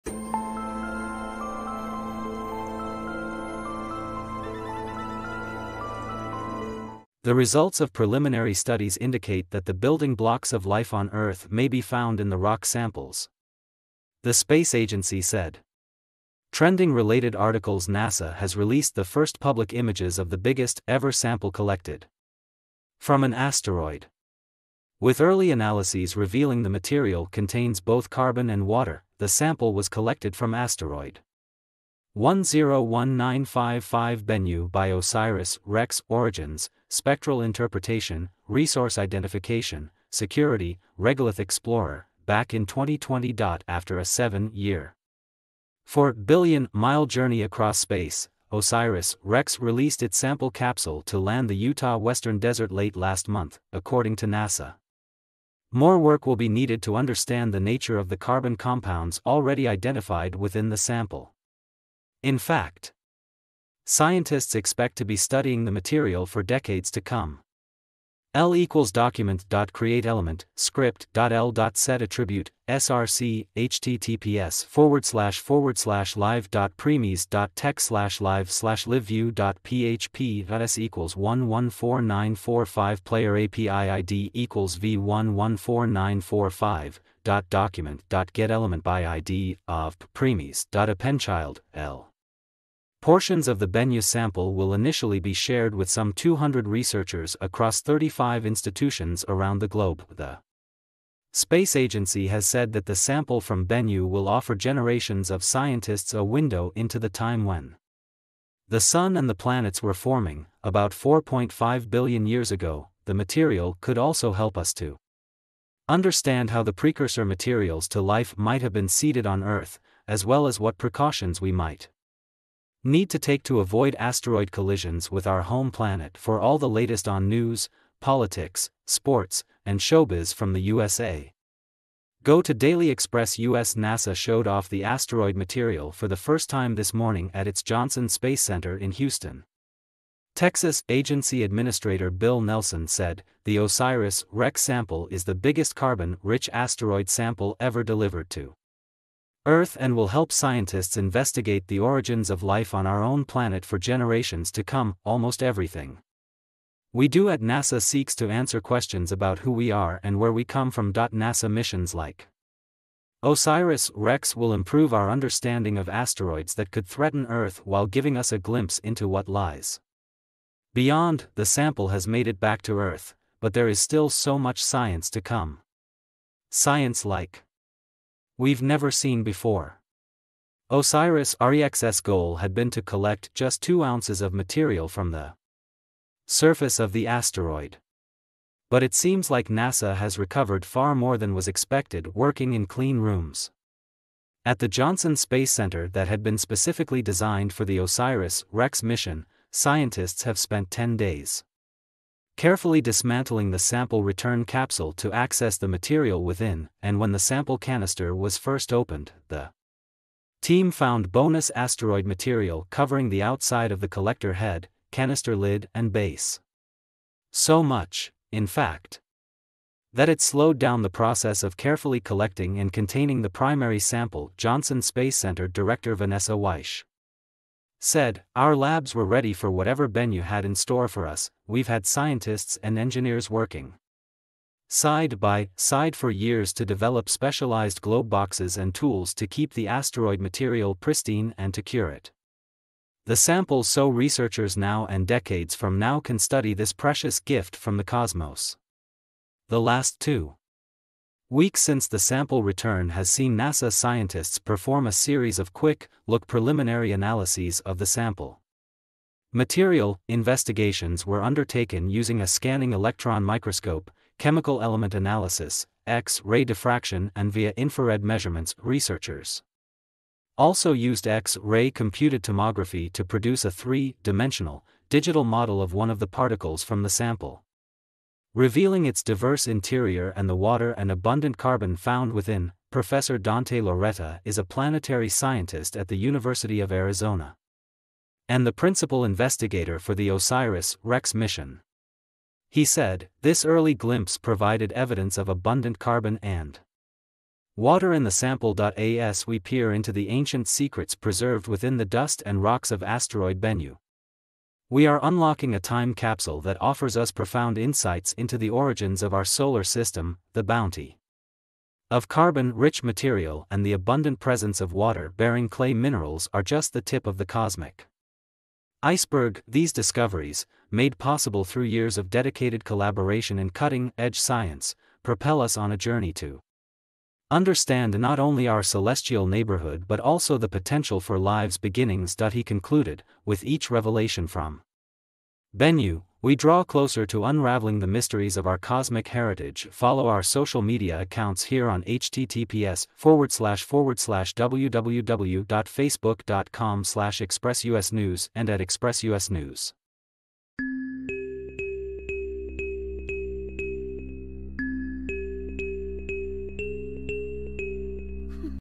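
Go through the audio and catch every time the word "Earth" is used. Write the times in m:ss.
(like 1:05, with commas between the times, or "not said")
0:11, 1:59, 2:29, 2:47, 2:52.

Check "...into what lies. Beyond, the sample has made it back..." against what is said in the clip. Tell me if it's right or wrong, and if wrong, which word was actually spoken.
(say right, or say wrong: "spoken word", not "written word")
right.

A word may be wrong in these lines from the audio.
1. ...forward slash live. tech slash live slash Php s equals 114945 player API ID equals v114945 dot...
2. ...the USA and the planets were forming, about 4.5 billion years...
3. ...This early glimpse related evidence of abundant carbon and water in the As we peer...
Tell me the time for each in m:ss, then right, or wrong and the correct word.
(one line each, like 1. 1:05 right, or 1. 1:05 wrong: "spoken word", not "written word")
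1. 1:15 right
2. 1:48 wrong: "Sun", not "USA"
3. 4:53 wrong: "provided", not "related".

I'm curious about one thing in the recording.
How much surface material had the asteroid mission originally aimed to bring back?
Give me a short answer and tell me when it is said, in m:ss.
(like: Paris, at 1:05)
2 ounces, at 3:03.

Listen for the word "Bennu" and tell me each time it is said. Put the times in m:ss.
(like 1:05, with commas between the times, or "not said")
0:34, 1:33, 1:43, 3:49, 5:03, 5:35.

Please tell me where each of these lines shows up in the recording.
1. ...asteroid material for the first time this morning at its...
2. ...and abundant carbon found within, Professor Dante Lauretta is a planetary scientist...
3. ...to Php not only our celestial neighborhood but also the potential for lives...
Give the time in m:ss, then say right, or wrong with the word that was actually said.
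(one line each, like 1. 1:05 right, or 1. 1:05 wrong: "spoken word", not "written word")
1. 2:14 right
2. 4:40 right
3. 5:26 wrong: "Understand", not "Php".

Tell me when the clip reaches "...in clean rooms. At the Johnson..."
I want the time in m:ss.
3:12.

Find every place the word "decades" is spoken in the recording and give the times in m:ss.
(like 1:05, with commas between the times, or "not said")
1:06, 4:05.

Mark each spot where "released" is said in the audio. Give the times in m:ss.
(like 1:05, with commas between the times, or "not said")
0:18, 0:49.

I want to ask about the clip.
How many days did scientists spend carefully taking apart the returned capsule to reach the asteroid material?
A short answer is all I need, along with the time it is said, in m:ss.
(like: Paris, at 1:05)
10 days, at 3:20.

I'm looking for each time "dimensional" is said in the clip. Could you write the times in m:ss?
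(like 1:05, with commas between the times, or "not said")
4:34.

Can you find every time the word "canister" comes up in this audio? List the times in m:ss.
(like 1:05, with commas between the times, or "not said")
3:27, 3:34.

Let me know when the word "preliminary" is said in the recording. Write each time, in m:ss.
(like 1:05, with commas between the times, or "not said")
0:07, 4:16.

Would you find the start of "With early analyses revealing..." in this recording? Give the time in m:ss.
0:24.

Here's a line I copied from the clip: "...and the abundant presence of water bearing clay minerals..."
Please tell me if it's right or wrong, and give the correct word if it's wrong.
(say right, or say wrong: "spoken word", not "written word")
right.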